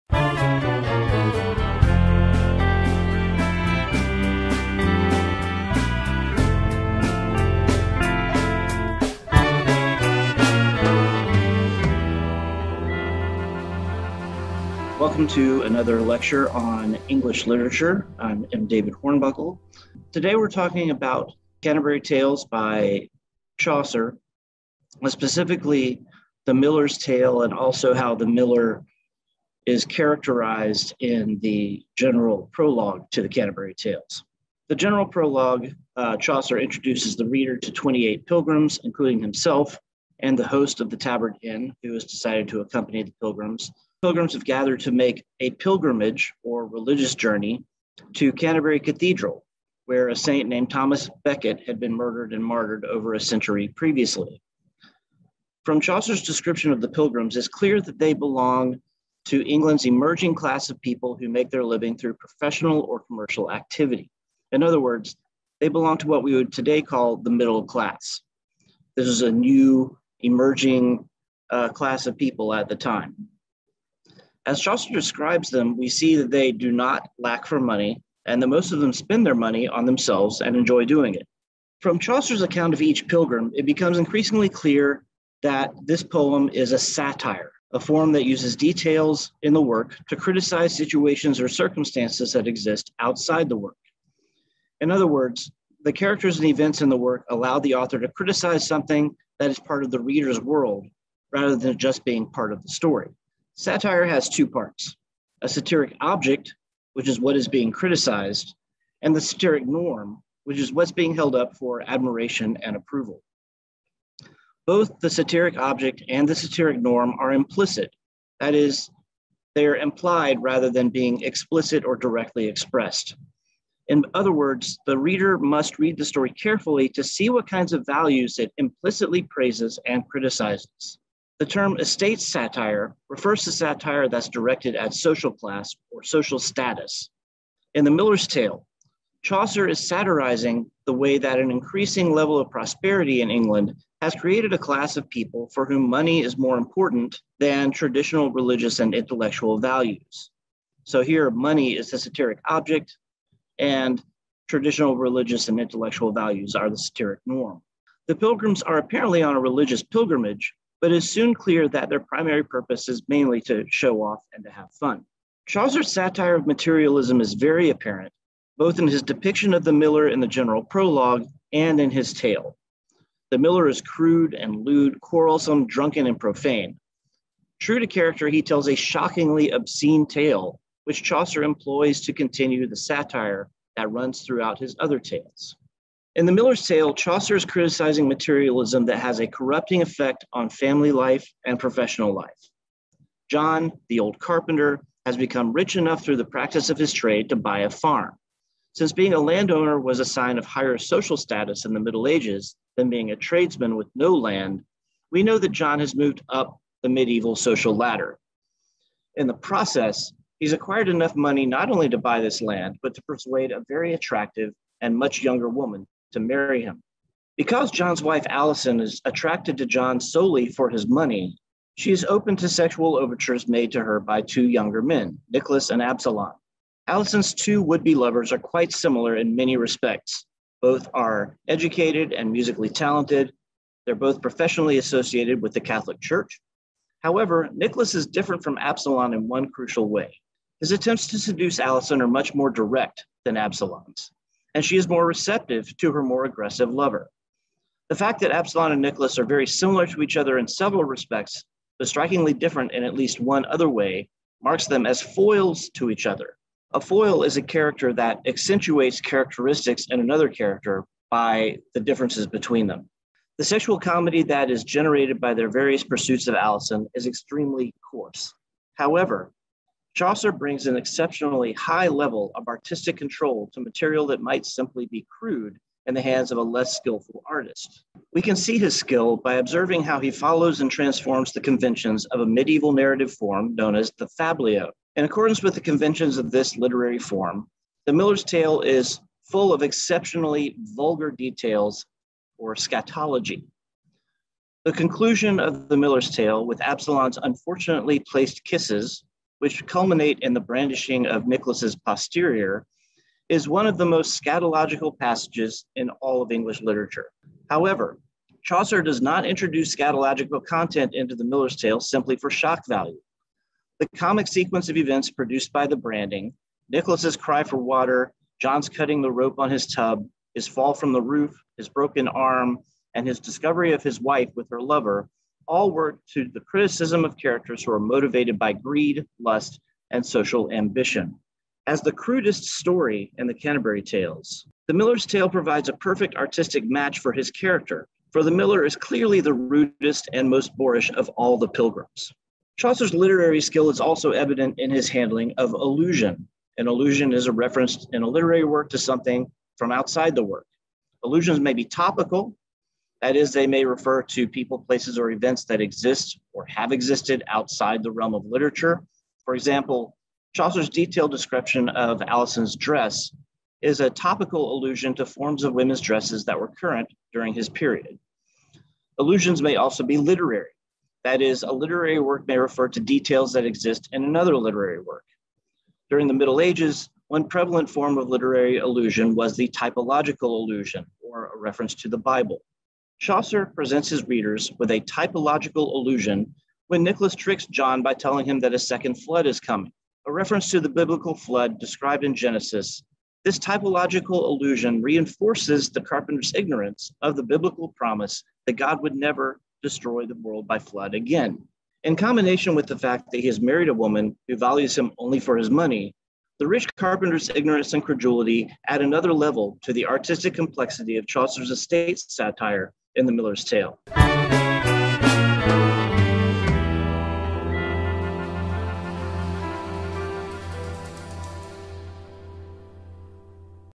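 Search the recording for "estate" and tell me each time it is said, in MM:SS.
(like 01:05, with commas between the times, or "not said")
02:11, 06:51.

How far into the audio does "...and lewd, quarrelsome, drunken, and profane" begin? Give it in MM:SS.
02:54.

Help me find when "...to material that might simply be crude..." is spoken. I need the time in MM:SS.
04:33.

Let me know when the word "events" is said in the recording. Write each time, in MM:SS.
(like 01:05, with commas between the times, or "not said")
01:36, 05:14, 05:55.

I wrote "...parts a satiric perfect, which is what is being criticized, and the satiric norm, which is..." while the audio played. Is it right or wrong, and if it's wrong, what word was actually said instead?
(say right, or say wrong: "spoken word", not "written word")
wrong: "object", not "perfect".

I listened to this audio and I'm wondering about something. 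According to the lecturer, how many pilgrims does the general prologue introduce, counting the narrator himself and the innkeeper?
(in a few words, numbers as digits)
28.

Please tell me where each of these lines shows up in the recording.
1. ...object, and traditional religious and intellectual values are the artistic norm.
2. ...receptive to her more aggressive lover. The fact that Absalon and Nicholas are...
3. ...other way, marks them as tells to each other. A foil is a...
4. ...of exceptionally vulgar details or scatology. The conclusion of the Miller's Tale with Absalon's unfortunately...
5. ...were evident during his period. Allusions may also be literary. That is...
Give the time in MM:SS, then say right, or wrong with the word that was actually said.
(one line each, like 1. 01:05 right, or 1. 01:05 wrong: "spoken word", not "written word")
1. 02:32 wrong: "satiric", not "artistic"
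2. 04:05 right
3. 04:13 wrong: "foils", not "tells"
4. 04:49 right
5. 06:06 wrong: "current", not "evident".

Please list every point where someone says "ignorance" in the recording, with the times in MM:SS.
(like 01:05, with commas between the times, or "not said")
06:36, 06:47.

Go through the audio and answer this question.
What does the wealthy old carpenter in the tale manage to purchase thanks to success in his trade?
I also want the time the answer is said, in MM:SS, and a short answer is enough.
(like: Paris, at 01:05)
a farm, at 03:17.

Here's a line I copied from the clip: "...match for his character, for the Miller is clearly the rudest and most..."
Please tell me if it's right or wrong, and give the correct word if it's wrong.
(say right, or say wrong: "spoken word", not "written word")
right.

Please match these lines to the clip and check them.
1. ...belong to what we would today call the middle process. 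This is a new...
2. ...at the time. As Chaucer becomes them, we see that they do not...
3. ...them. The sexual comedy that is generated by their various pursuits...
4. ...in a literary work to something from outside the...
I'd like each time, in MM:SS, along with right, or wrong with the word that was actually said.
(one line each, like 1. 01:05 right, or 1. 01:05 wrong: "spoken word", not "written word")
1. 01:05 wrong: "class", not "process"
2. 01:12 wrong: "describes", not "becomes"
3. 04:22 right
4. 05:47 right.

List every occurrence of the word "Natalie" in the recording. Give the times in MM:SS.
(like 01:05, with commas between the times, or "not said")
not said.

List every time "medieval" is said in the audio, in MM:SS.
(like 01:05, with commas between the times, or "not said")
03:26, 04:42.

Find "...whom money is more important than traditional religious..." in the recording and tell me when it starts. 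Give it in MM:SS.
02:25.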